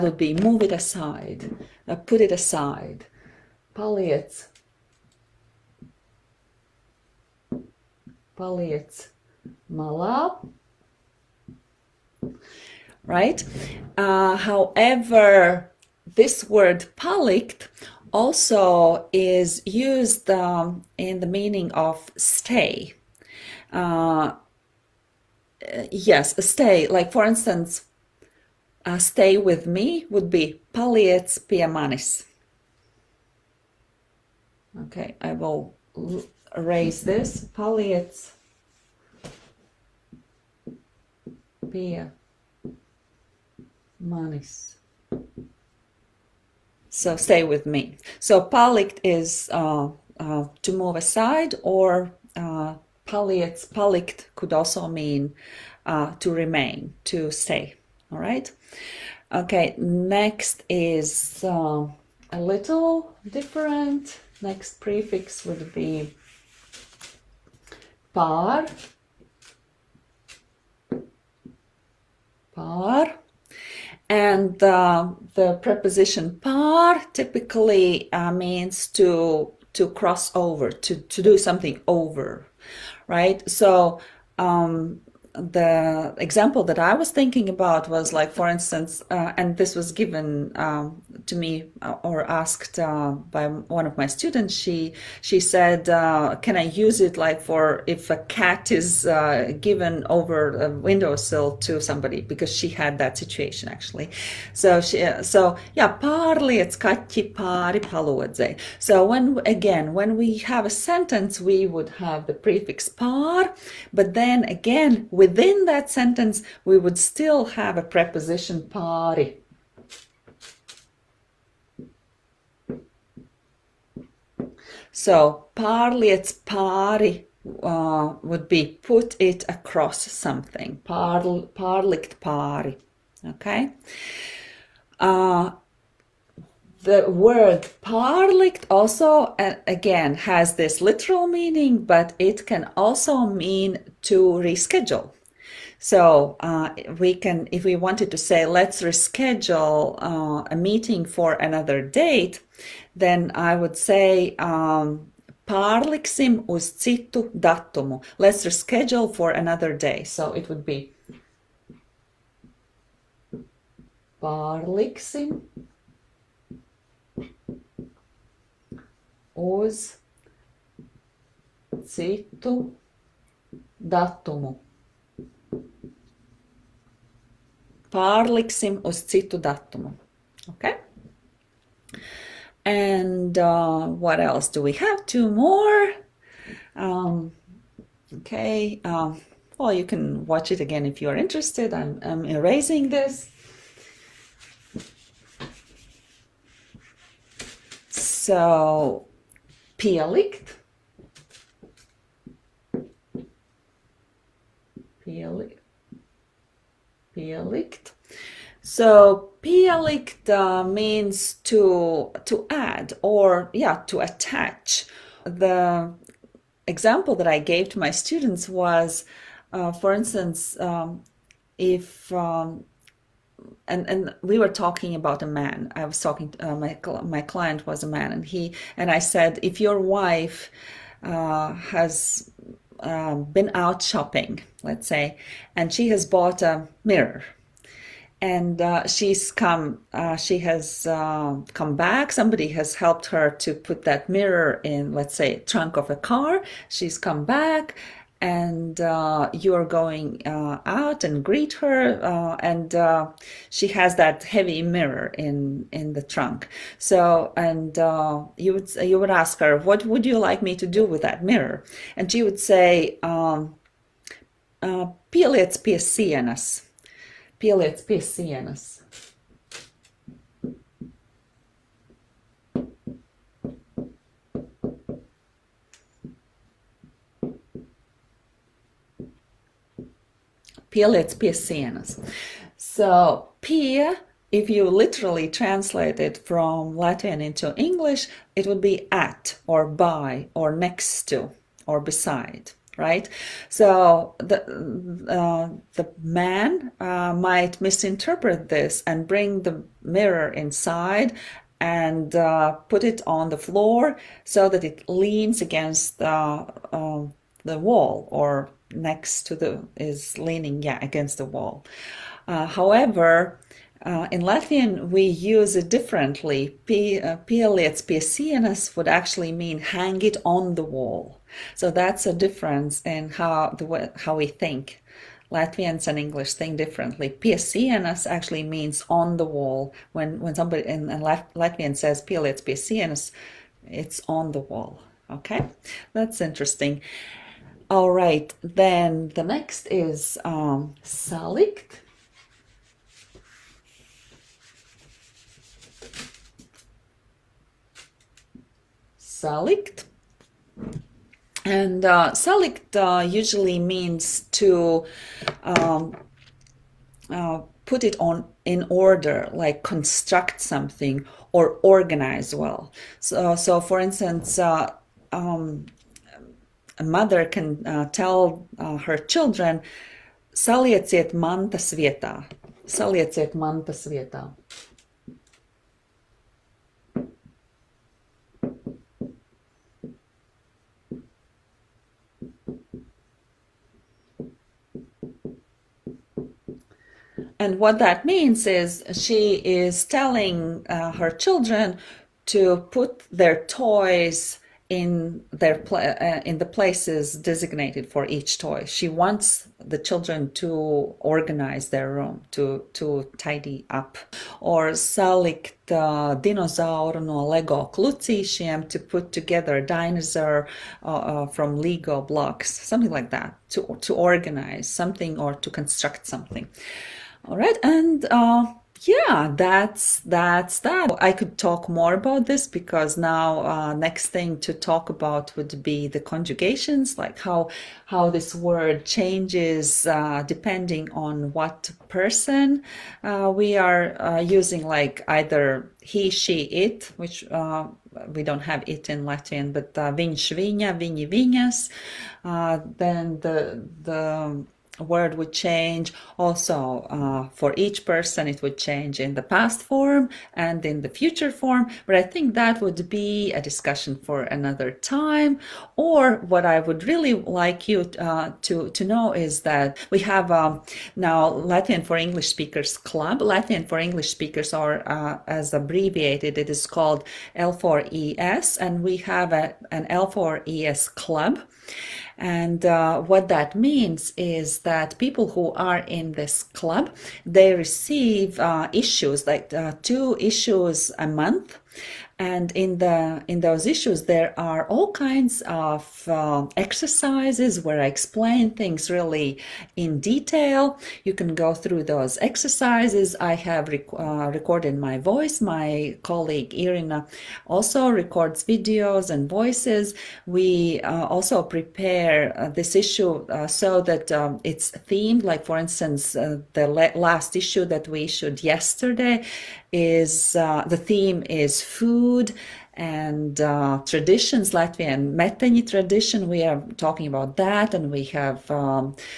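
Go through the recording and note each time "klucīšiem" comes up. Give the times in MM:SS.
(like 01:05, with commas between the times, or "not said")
06:47.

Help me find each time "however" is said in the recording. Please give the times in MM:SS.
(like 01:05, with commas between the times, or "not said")
00:14, 05:12.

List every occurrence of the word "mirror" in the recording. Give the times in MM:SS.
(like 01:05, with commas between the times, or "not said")
03:56, 04:04, 04:14, 04:21, 04:59.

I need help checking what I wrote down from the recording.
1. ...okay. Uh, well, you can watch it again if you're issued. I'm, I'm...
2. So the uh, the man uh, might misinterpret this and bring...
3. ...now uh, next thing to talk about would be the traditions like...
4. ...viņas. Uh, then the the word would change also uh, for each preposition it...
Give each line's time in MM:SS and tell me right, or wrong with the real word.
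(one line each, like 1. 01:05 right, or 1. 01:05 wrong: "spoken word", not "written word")
1. 03:08 wrong: "interested", not "issued"
2. 04:53 right
3. 07:02 wrong: "conjugations", not "traditions"
4. 07:21 wrong: "person", not "preposition".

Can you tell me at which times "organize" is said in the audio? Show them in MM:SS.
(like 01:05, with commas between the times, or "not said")
06:01, 06:40, 06:53.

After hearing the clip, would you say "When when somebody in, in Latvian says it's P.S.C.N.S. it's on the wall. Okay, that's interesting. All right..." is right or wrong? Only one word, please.
right.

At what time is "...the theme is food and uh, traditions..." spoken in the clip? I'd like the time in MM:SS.
08:30.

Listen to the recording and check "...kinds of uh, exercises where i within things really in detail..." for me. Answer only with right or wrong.
wrong.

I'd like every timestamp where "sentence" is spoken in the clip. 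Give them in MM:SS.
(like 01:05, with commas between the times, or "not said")
01:50, 01:55.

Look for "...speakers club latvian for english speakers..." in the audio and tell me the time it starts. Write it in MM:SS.
07:42.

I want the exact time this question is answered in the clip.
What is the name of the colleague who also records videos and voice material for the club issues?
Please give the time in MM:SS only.
08:16.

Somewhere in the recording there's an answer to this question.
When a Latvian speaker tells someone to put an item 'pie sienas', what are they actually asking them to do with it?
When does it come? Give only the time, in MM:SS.
05:19.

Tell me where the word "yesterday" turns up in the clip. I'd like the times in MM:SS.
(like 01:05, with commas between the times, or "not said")
08:28.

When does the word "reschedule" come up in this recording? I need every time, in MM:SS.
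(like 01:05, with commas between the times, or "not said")
02:24, 02:28, 02:38.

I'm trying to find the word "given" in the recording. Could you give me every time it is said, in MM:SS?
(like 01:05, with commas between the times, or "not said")
01:29, 01:39.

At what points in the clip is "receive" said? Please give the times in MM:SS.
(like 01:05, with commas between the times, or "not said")
07:57.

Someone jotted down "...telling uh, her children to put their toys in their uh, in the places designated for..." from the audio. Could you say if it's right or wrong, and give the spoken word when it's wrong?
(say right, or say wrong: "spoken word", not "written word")
right.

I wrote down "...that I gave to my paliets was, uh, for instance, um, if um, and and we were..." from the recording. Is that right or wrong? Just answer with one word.
wrong.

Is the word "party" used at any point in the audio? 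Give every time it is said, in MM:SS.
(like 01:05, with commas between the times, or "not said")
01:58, 02:06.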